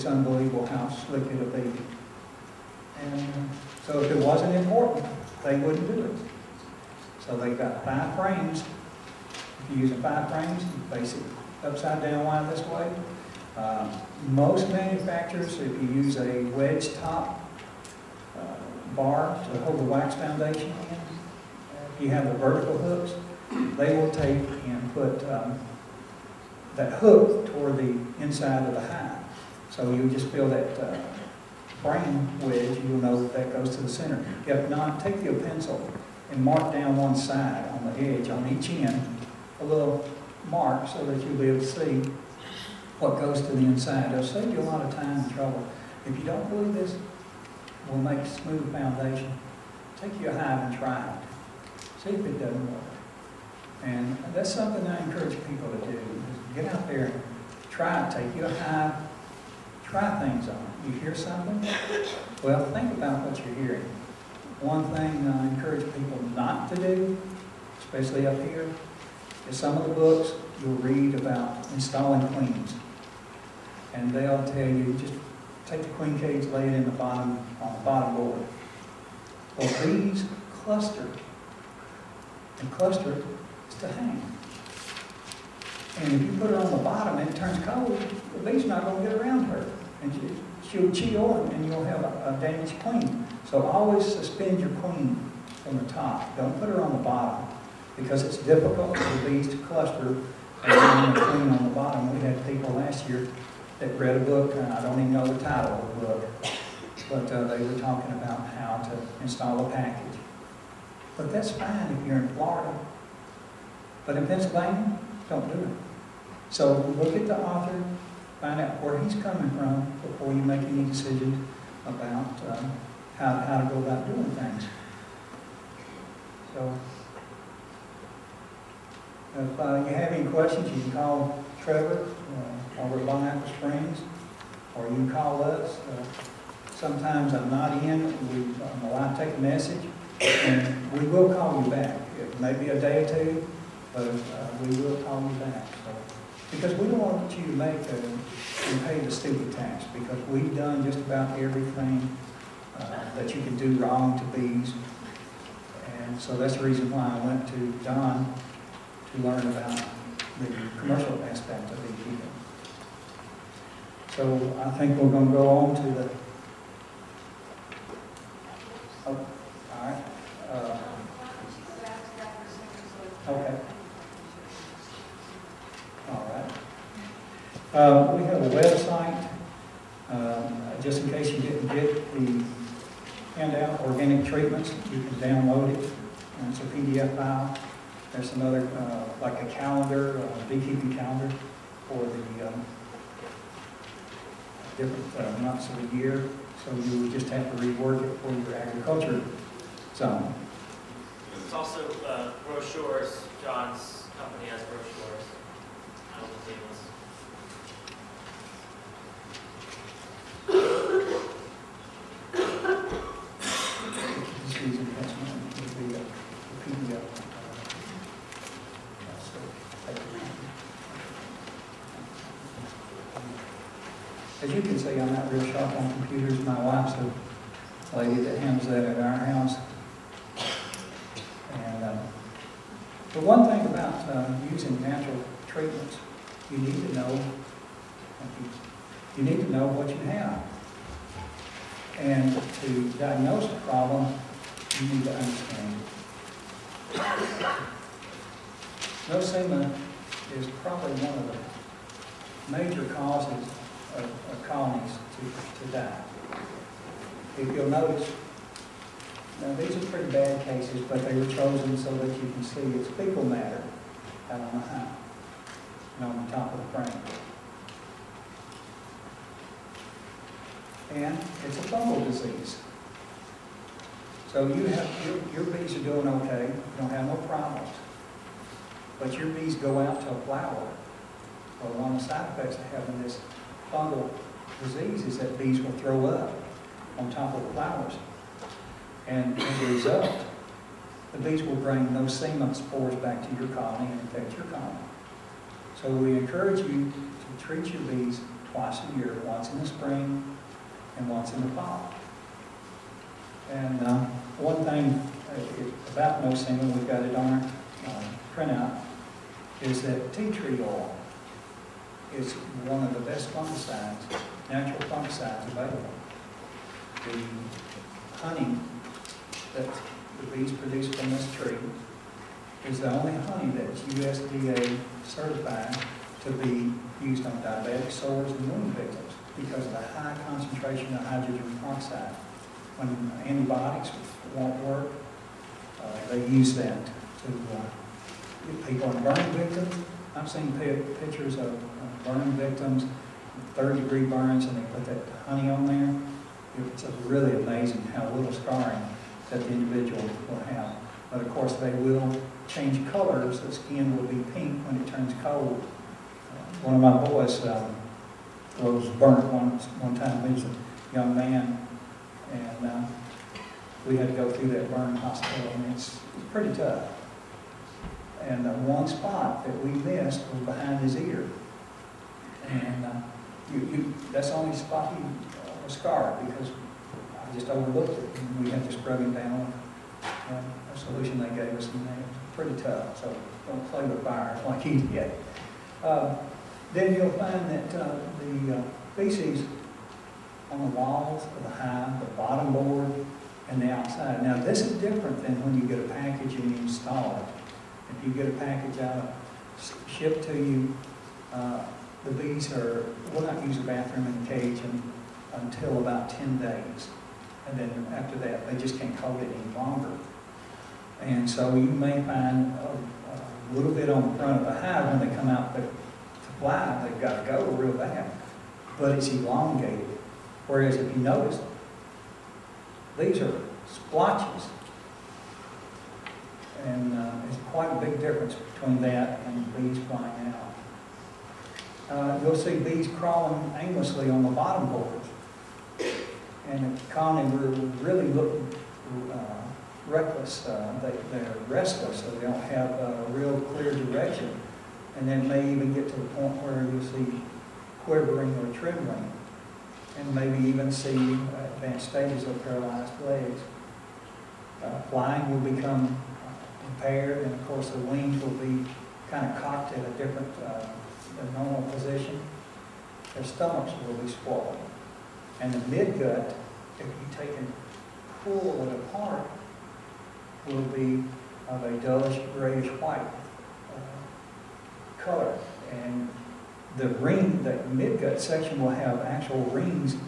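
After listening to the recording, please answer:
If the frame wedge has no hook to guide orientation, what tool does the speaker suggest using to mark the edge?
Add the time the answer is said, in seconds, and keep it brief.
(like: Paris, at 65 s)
pencil, at 35 s.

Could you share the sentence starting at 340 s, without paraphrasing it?
I've seen pictures of burn victims, third degree burns, and they put that honey on there.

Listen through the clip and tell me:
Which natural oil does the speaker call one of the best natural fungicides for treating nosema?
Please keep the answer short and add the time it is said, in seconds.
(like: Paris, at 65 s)
tea tree oil, at 310 s.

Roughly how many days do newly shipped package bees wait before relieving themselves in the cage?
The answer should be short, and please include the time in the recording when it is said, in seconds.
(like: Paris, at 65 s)
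10, at 406 s.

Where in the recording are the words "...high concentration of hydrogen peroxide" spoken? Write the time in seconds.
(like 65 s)
329 s.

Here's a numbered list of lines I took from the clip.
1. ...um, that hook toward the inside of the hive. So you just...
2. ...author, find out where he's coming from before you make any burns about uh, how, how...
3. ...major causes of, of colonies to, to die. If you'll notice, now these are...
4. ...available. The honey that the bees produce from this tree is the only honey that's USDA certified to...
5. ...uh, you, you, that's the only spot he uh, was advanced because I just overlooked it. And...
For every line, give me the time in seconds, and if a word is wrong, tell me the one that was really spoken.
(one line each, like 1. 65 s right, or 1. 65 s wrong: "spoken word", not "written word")
1. 25 s right
2. 117 s wrong: "decisions", not "burns"
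3. 252 s right
4. 315 s right
5. 372 s wrong: "scarred", not "advanced".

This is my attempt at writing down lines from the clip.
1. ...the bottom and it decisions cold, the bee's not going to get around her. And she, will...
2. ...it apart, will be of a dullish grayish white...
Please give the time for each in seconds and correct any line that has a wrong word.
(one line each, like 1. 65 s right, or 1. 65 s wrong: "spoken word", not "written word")
1. 86 s wrong: "turns", not "decisions"
2. 468 s right.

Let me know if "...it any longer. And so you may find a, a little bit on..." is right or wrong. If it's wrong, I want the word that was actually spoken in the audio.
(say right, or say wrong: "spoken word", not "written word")
right.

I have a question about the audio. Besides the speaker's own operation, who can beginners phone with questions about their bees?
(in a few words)
Trevor.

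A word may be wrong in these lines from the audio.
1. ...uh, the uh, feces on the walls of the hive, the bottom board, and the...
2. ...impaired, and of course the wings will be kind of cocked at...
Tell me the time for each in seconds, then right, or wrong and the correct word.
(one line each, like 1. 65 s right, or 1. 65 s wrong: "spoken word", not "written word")
1. 387 s right
2. 456 s right.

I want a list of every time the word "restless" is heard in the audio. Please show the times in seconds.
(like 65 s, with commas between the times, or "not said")
441 s.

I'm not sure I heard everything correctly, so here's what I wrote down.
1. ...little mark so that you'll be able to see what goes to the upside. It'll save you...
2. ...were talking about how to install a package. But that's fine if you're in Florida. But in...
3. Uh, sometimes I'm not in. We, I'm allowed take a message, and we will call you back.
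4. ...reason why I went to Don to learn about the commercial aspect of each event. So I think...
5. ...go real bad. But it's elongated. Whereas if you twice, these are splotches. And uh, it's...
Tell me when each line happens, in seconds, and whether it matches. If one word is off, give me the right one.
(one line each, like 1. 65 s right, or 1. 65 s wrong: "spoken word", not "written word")
1. 39 s wrong: "inside", not "upside"
2. 107 s right
3. 135 s right
4. 156 s right
5. 417 s wrong: "notice", not "twice".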